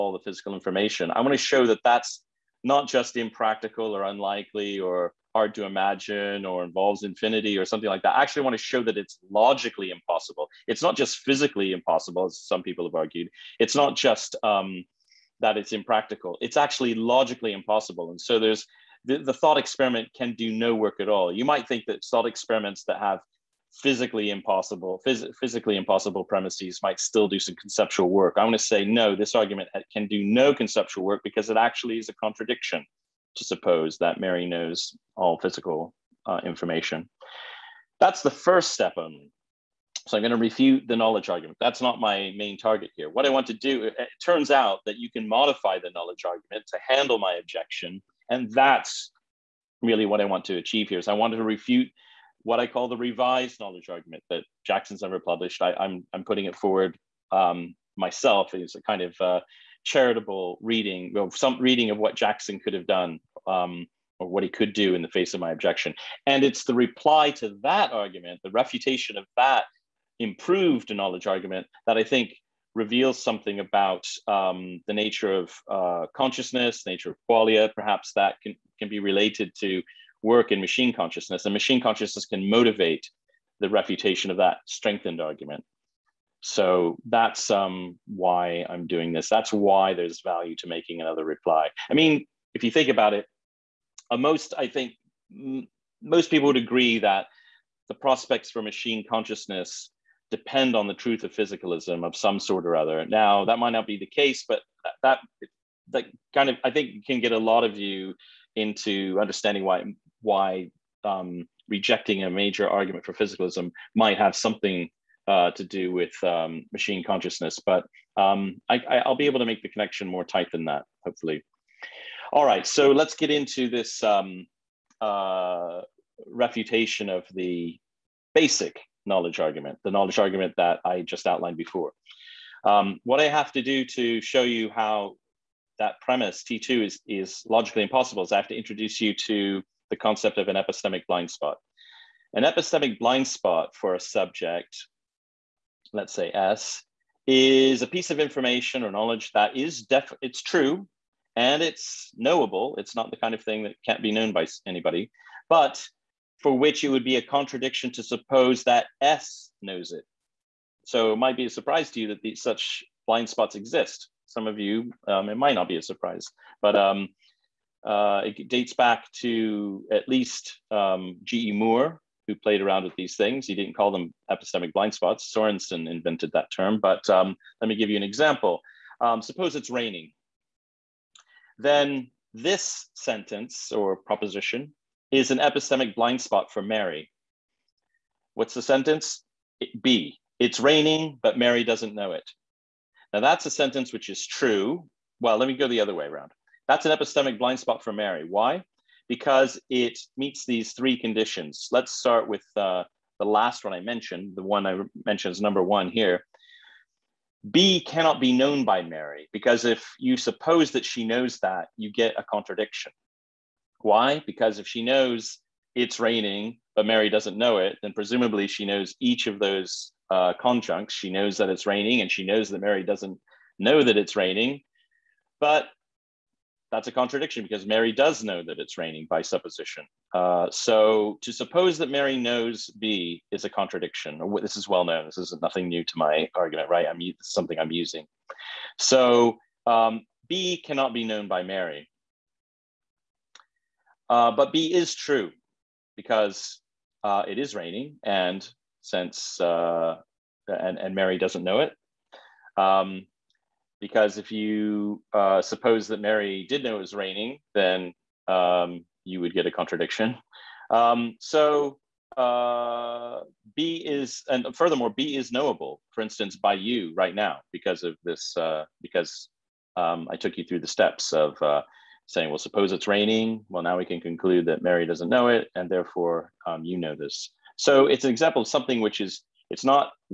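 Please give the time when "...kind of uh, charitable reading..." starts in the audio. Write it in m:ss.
0:58.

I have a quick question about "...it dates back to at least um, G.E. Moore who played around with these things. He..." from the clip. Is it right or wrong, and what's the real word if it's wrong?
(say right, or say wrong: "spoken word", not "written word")
right.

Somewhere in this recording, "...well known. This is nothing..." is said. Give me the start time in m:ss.
3:54.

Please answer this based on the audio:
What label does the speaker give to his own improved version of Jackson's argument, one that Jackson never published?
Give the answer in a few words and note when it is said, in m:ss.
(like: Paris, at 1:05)
revised knowledge argument, at 0:52.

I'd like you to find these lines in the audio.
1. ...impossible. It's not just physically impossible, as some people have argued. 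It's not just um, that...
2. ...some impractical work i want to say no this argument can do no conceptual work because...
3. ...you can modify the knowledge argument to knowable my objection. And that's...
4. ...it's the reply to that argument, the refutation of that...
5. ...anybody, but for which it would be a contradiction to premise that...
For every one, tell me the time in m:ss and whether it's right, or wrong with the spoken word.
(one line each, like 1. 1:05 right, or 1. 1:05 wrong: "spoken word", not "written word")
1. 0:09 right
2. 0:27 wrong: "conceptual", not "impractical"
3. 0:44 wrong: "handle", not "knowable"
4. 1:06 right
5. 2:34 wrong: "suppose", not "premise".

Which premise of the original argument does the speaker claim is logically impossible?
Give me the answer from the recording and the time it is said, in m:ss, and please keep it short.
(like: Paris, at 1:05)
T2, at 2:16.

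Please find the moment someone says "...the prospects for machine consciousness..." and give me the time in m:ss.
1:37.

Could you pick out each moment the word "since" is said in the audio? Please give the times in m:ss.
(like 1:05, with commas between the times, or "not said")
4:08.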